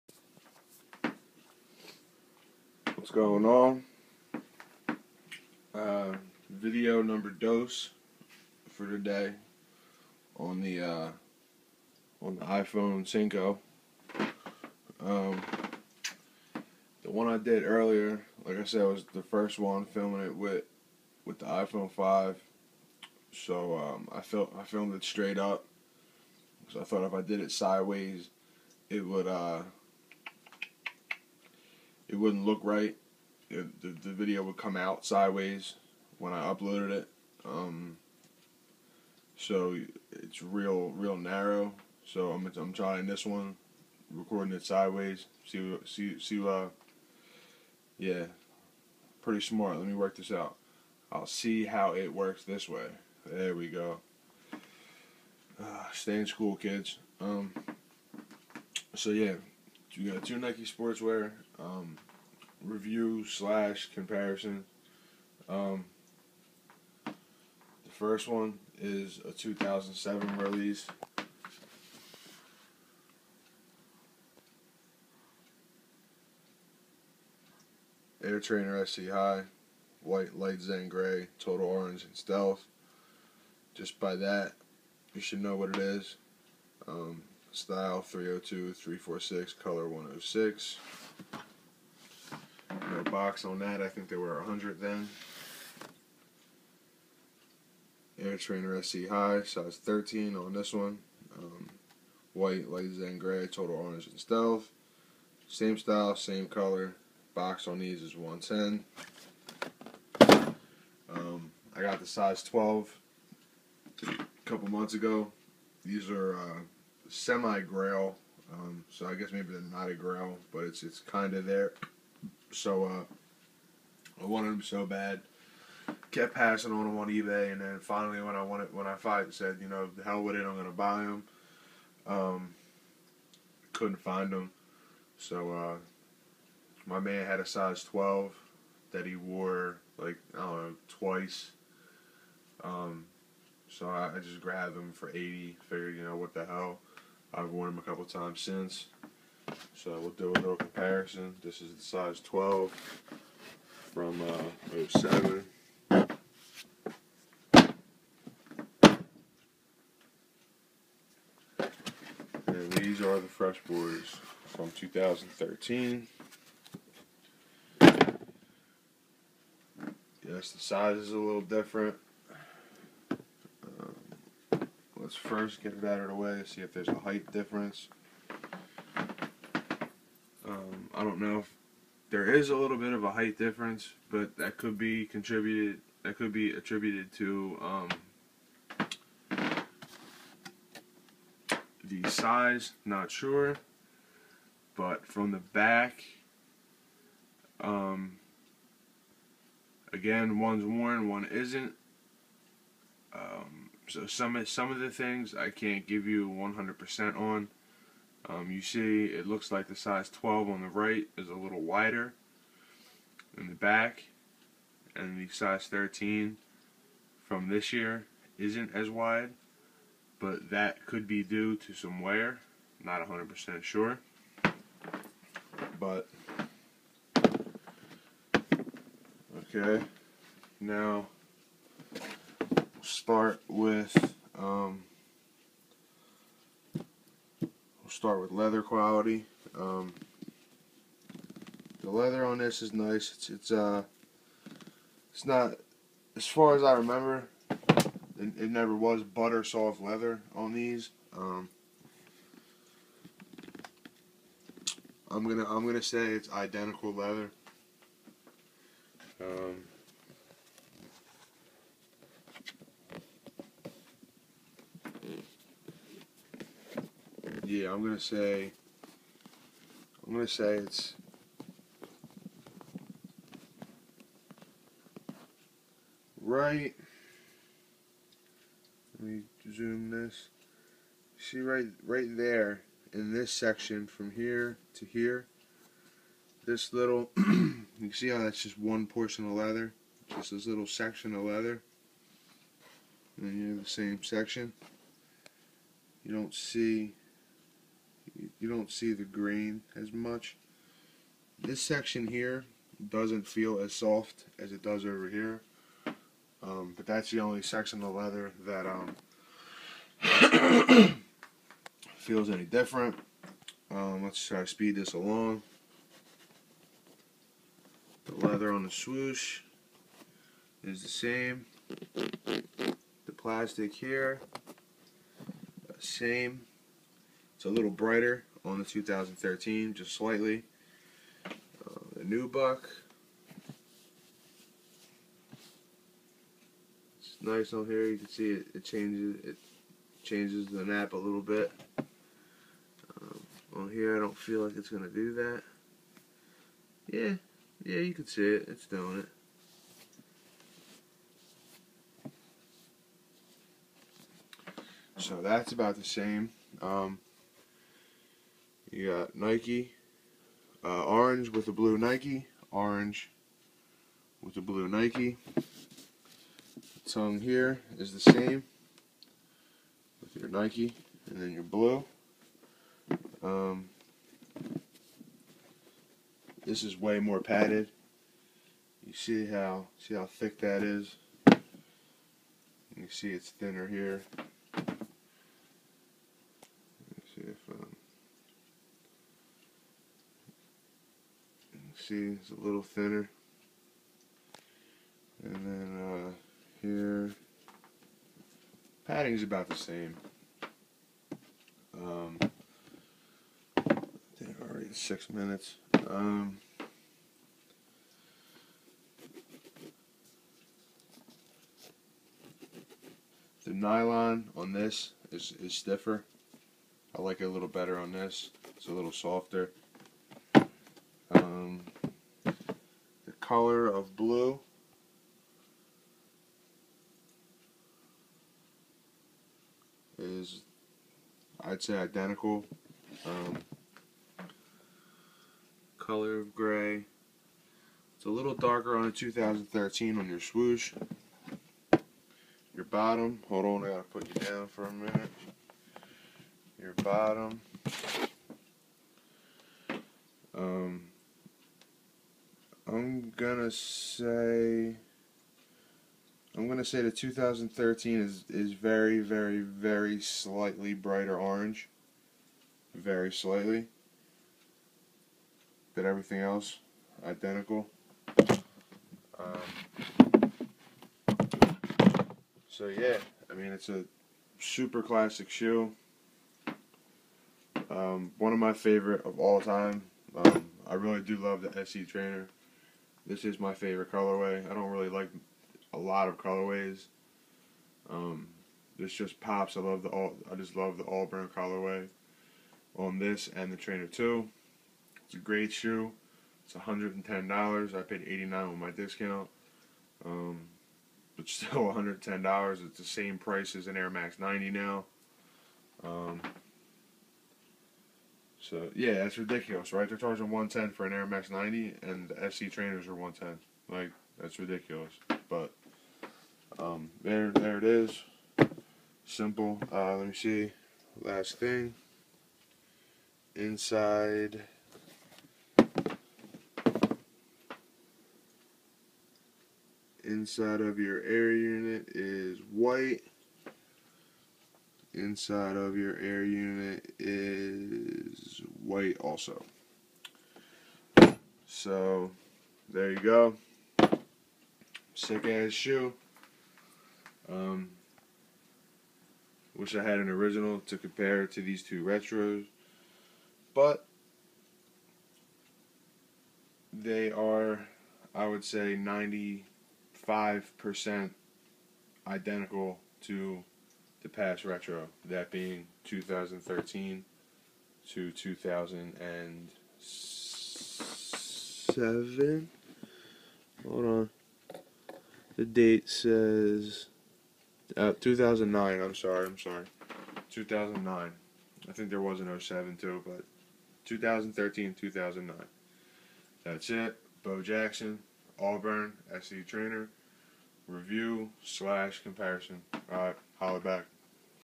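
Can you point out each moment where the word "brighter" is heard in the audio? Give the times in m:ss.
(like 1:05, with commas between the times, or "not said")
5:27, 7:40.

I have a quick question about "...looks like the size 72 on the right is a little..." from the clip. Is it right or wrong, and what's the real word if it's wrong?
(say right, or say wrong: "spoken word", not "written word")
wrong: "12", not "72".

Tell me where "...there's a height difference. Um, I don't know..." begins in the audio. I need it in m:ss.
2:56.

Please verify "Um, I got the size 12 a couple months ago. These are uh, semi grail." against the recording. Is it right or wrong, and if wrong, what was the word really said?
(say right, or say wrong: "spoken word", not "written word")
right.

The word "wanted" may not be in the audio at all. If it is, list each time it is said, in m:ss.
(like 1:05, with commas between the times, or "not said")
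2:04, 2:08.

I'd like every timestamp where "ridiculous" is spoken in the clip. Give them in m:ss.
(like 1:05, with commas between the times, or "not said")
8:29, 8:34.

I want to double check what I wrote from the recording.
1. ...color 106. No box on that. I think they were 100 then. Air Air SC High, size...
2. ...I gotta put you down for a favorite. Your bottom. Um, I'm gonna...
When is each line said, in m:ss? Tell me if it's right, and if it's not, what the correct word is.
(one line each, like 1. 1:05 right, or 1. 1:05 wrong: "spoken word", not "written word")
1. 1:29 wrong: "Trainer", not "Air"
2. 7:23 wrong: "minute", not "favorite".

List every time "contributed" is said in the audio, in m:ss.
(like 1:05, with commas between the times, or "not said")
3:05.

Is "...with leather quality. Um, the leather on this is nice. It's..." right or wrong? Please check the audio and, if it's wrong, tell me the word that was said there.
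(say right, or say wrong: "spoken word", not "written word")
right.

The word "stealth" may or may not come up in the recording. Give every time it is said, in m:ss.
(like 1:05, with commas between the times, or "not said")
1:22, 1:44.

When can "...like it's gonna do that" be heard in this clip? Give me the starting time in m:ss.
5:44.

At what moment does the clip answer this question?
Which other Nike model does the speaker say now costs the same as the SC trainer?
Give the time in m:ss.
8:23.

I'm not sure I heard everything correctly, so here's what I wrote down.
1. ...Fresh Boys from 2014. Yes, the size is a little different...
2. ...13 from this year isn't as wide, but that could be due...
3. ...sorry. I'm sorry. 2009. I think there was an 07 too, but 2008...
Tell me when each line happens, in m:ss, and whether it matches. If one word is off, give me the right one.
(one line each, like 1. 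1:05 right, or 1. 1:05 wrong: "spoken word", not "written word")
1. 2:43 wrong: "2013", not "2014"
2. 3:35 right
3. 9:38 wrong: "2013", not "2008".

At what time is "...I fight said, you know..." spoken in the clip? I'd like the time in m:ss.
2:08.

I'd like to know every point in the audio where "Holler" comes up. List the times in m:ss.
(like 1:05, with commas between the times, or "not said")
9:53.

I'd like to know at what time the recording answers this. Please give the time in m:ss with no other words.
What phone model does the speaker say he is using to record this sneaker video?
0:12.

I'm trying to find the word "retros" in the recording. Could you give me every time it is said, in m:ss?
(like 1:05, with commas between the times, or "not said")
9:11, 9:24.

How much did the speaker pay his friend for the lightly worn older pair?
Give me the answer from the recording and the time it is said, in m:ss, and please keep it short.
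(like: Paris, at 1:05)
80, at 2:25.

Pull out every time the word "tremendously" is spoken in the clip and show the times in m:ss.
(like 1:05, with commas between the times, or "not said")
not said.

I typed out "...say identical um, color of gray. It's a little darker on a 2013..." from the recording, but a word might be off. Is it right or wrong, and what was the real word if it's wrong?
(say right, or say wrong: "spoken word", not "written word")
right.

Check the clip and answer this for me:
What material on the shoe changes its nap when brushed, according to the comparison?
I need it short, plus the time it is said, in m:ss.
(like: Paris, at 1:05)
Nubuck, at 5:32.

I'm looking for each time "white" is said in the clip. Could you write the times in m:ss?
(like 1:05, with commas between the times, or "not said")
1:20, 1:42, 8:52, 8:58.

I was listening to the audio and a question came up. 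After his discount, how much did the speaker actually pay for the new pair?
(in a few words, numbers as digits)
89.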